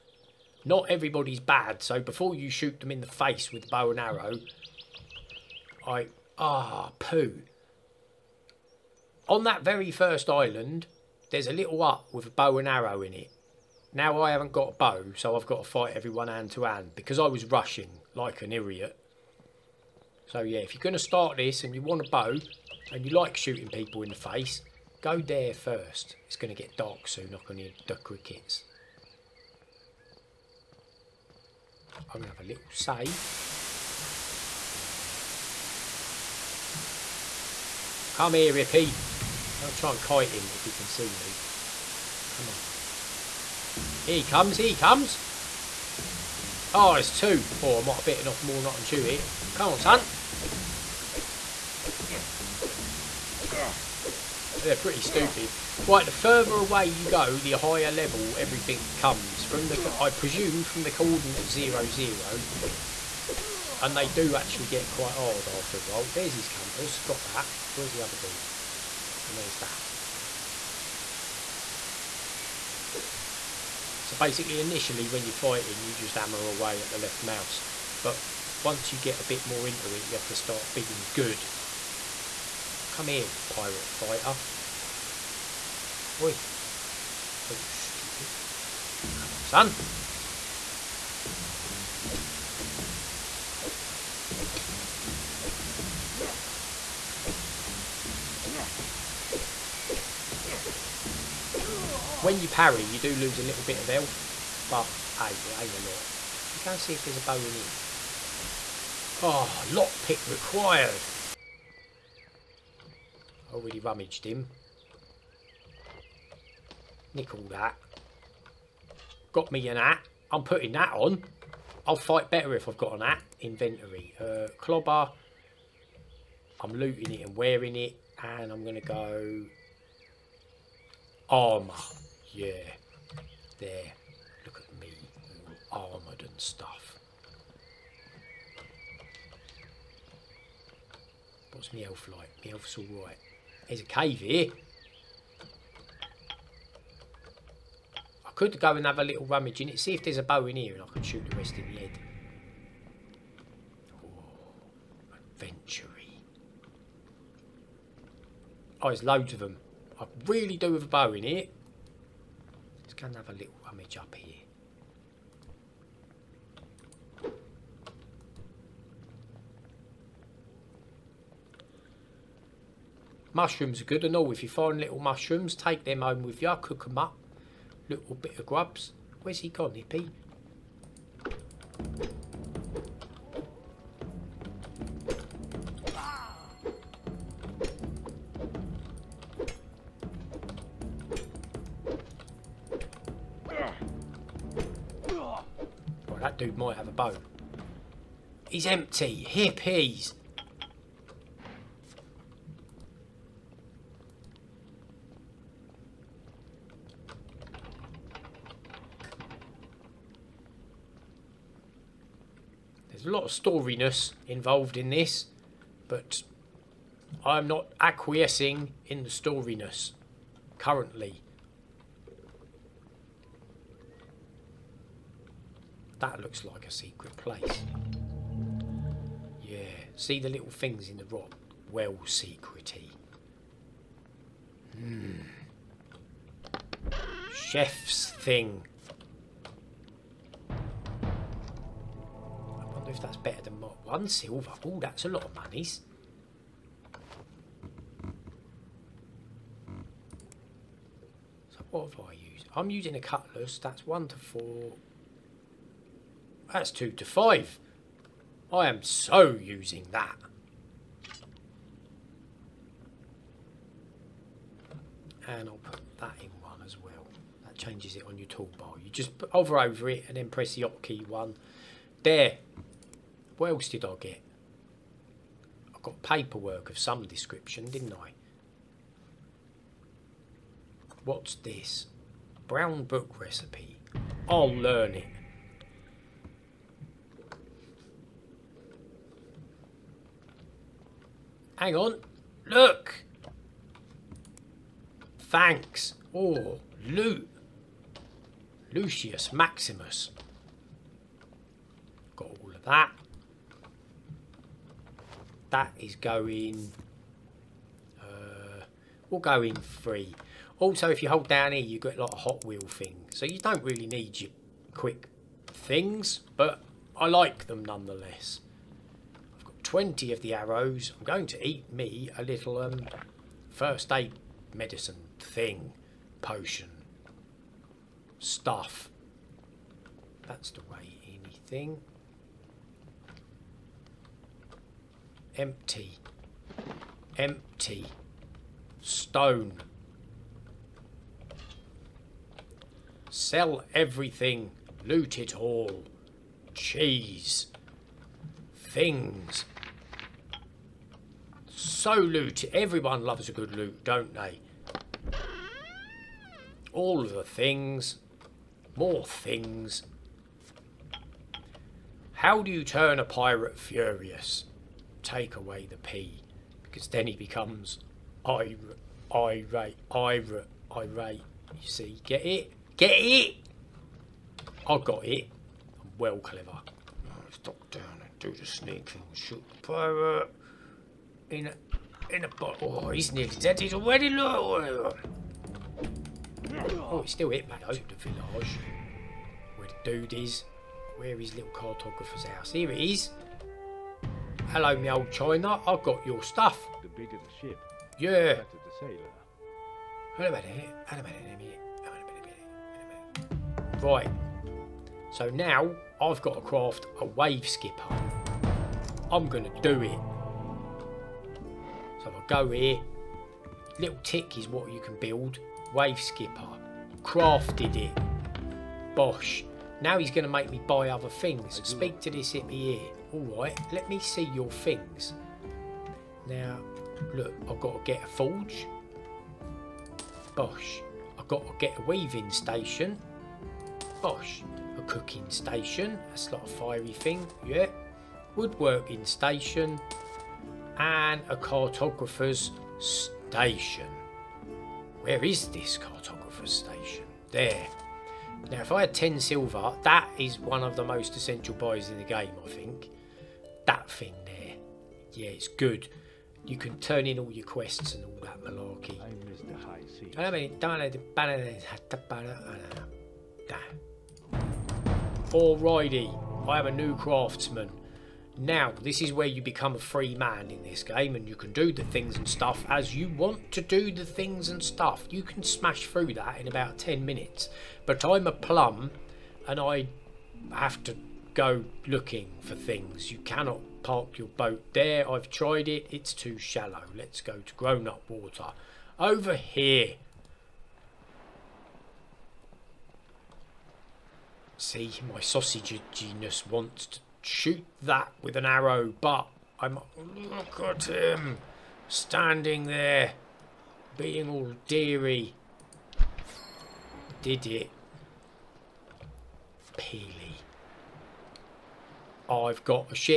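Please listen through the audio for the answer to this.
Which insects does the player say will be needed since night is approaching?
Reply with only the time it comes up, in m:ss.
0:27.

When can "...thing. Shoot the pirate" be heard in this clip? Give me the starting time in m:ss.
6:18.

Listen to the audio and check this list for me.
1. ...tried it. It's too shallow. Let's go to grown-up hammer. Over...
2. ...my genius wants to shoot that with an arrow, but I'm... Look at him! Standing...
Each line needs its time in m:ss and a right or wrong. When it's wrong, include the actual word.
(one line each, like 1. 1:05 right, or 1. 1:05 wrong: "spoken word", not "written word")
1. 8:05 wrong: "water", not "hammer"
2. 8:15 right.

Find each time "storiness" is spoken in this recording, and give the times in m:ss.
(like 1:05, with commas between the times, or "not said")
3:33, 3:39.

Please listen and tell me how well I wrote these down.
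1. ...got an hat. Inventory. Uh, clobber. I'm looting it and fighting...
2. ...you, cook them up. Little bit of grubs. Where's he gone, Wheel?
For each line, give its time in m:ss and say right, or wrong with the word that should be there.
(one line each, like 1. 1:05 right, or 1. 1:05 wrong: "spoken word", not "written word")
1. 2:02 wrong: "wearing", not "fighting"
2. 2:56 wrong: "Hippy", not "Wheel".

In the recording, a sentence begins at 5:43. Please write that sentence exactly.
Sell everything, loot it all, cheese, things.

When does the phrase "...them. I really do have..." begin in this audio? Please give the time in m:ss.
2:39.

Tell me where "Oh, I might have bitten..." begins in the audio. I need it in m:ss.
0:47.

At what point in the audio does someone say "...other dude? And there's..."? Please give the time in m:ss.
1:08.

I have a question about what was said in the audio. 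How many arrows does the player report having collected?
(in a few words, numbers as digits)
20.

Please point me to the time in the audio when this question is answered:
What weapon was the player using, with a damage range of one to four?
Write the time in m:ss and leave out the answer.
4:13.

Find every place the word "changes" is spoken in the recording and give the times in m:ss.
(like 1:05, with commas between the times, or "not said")
4:27.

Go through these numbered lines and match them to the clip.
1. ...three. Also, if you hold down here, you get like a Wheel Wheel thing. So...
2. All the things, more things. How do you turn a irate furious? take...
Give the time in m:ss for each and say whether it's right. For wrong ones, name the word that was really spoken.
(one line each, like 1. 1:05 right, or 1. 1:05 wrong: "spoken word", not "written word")
1. 5:09 wrong: "Hot", not "Wheel"
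2. 5:56 wrong: "pirate", not "irate".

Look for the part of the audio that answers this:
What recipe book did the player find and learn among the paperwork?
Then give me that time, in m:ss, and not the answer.
4:42.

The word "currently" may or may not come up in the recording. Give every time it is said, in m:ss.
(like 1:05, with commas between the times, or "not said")
3:40.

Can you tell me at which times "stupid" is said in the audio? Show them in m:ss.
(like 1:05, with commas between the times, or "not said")
0:55, 1:27.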